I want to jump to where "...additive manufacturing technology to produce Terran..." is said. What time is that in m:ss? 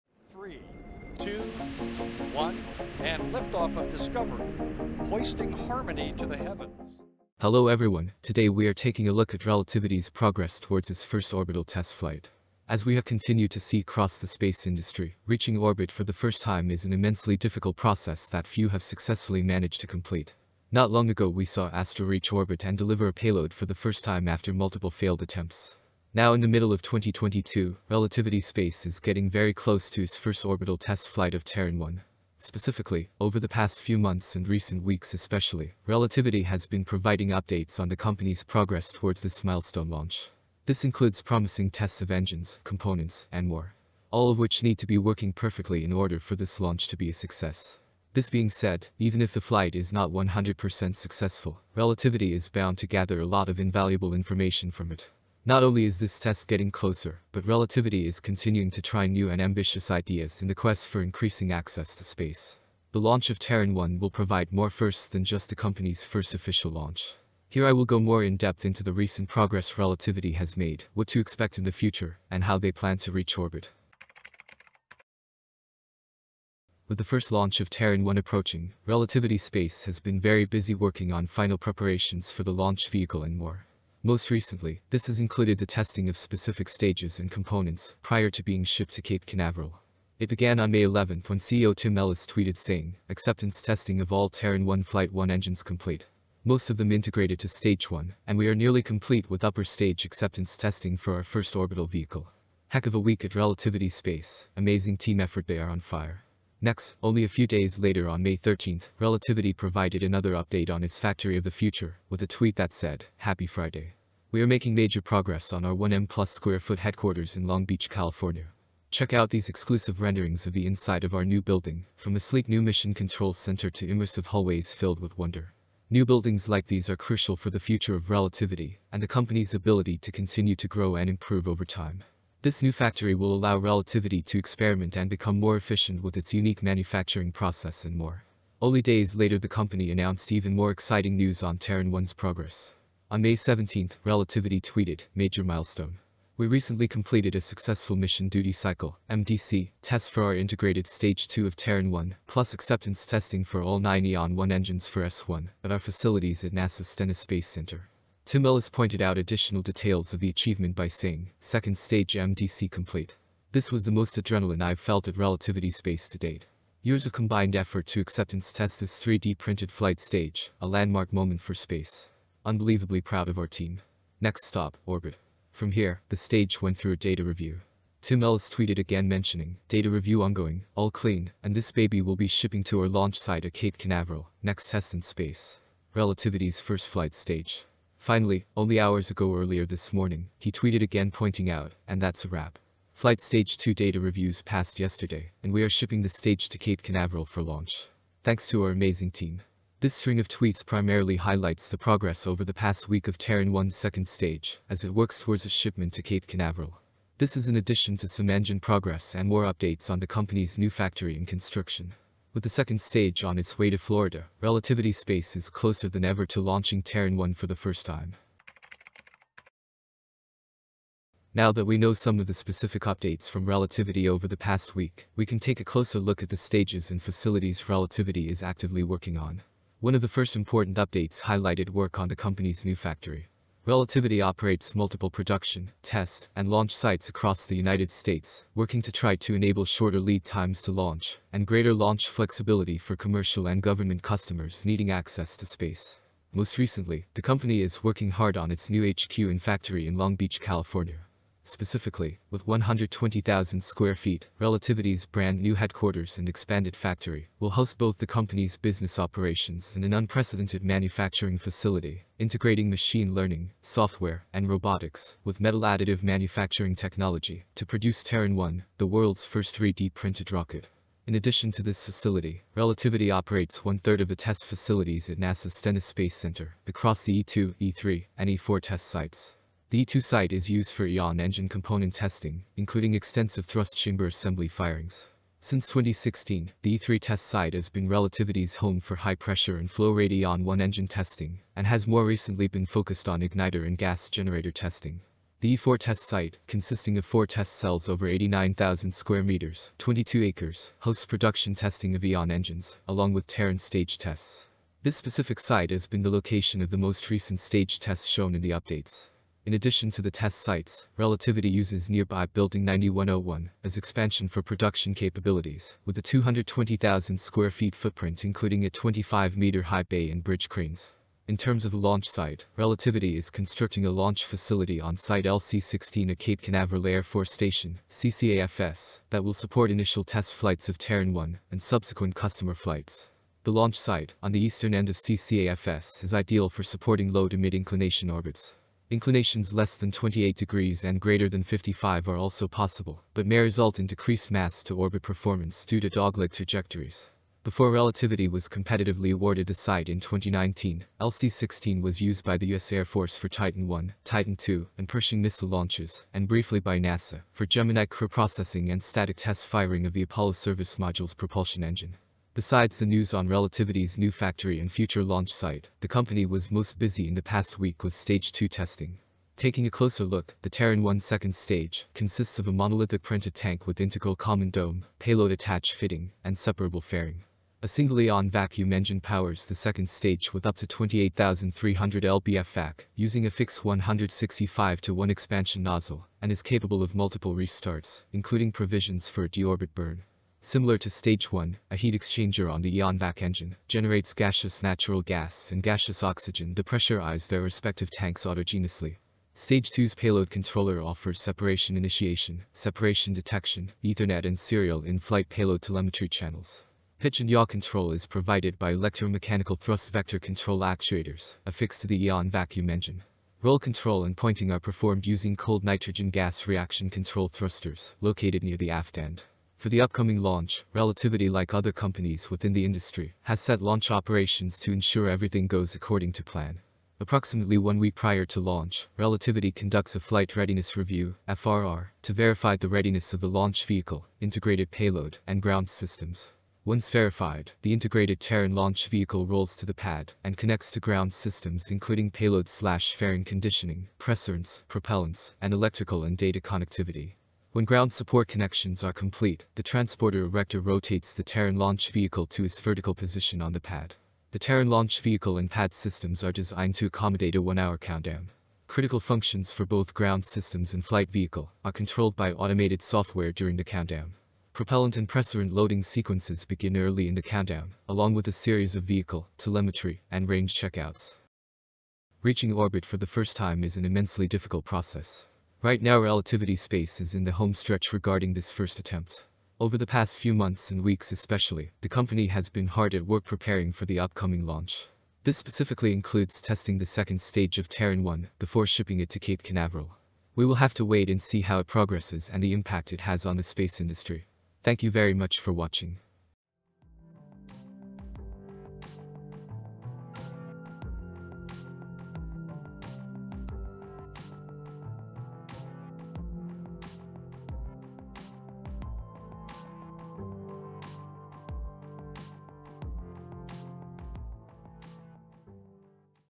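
4:25.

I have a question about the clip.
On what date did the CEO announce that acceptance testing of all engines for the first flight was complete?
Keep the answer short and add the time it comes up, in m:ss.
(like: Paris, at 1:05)
May 11, at 1:30.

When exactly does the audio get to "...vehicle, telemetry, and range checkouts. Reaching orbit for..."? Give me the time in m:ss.
7:48.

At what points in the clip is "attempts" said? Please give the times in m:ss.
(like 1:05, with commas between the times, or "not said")
0:25, 7:58.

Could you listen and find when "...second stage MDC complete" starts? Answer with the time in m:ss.
2:41.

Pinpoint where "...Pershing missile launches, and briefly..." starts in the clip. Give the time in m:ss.
5:54.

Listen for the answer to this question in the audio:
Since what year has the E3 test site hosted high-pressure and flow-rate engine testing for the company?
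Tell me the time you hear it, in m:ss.
4:45.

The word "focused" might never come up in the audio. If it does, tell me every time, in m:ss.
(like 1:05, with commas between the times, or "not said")
4:52.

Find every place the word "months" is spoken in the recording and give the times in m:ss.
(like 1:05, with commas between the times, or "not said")
0:33, 8:00.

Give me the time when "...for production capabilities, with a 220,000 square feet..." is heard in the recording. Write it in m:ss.
5:14.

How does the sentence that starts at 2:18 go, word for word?
Only days later the company announced even more exciting news on Terran 1's progress.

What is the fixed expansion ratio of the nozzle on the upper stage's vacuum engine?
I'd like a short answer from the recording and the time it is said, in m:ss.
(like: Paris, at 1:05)
165 to 1, at 6:23.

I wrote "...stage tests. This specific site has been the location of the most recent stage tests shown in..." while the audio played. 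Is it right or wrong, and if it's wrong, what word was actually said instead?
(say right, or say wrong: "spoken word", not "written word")
right.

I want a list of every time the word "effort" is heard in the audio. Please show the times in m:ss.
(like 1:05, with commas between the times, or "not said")
1:45, 2:47.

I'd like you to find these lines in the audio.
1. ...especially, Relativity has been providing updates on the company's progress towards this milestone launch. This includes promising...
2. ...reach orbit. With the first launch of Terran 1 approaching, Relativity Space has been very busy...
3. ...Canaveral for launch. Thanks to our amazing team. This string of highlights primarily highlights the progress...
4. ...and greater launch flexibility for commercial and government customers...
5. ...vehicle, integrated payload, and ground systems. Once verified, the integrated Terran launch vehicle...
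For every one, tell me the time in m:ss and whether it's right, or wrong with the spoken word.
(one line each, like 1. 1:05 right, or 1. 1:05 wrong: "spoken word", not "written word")
1. 0:35 right
2. 1:13 right
3. 3:16 wrong: "tweets", not "highlights"
4. 4:01 right
5. 7:13 right.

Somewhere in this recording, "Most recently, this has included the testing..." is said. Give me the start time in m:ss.
1:24.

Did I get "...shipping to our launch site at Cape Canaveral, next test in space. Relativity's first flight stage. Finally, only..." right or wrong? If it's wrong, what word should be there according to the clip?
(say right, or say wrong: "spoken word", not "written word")
right.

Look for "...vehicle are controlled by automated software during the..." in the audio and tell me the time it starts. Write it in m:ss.
7:41.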